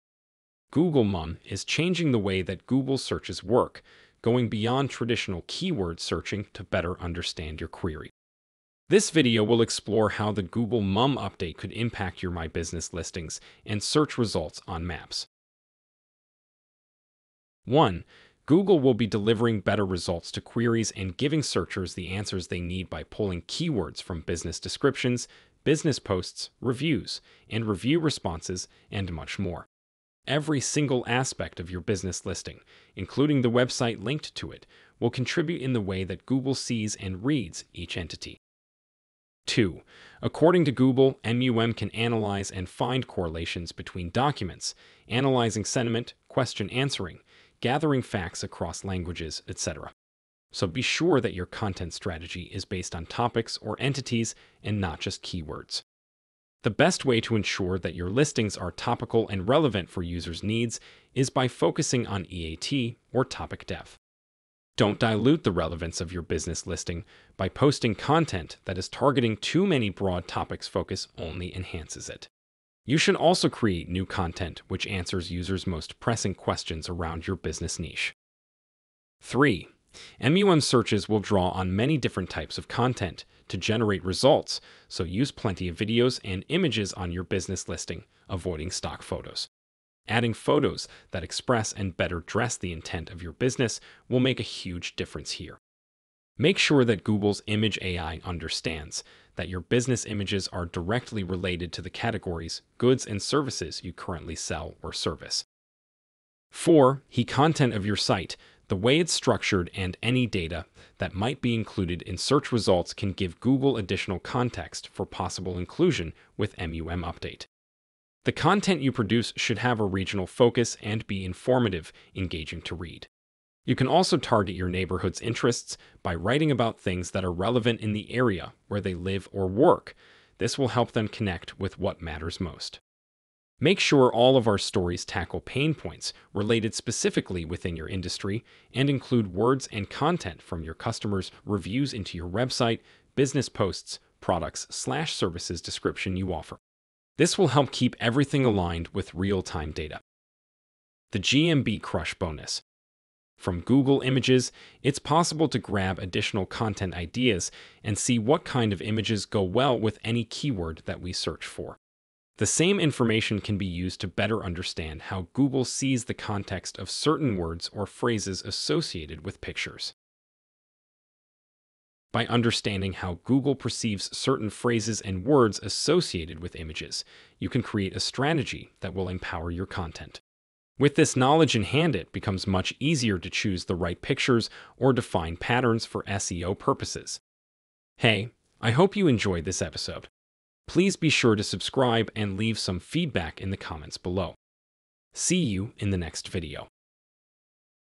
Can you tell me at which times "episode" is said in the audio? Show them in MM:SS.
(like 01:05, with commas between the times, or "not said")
03:09.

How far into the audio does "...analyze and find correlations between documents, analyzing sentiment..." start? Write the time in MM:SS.
00:41.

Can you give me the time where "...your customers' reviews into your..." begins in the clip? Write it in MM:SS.
02:20.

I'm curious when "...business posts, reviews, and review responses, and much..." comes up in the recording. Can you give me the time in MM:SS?
00:25.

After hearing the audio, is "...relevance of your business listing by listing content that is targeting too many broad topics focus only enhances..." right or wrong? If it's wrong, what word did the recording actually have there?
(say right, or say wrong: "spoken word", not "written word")
wrong: "posting", not "listing".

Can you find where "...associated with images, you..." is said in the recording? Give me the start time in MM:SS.
02:55.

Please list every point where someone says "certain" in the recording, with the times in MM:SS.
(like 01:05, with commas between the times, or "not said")
02:46, 02:54.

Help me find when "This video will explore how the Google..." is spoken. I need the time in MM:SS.
00:08.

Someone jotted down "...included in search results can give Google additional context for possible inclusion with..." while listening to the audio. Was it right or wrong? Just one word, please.
right.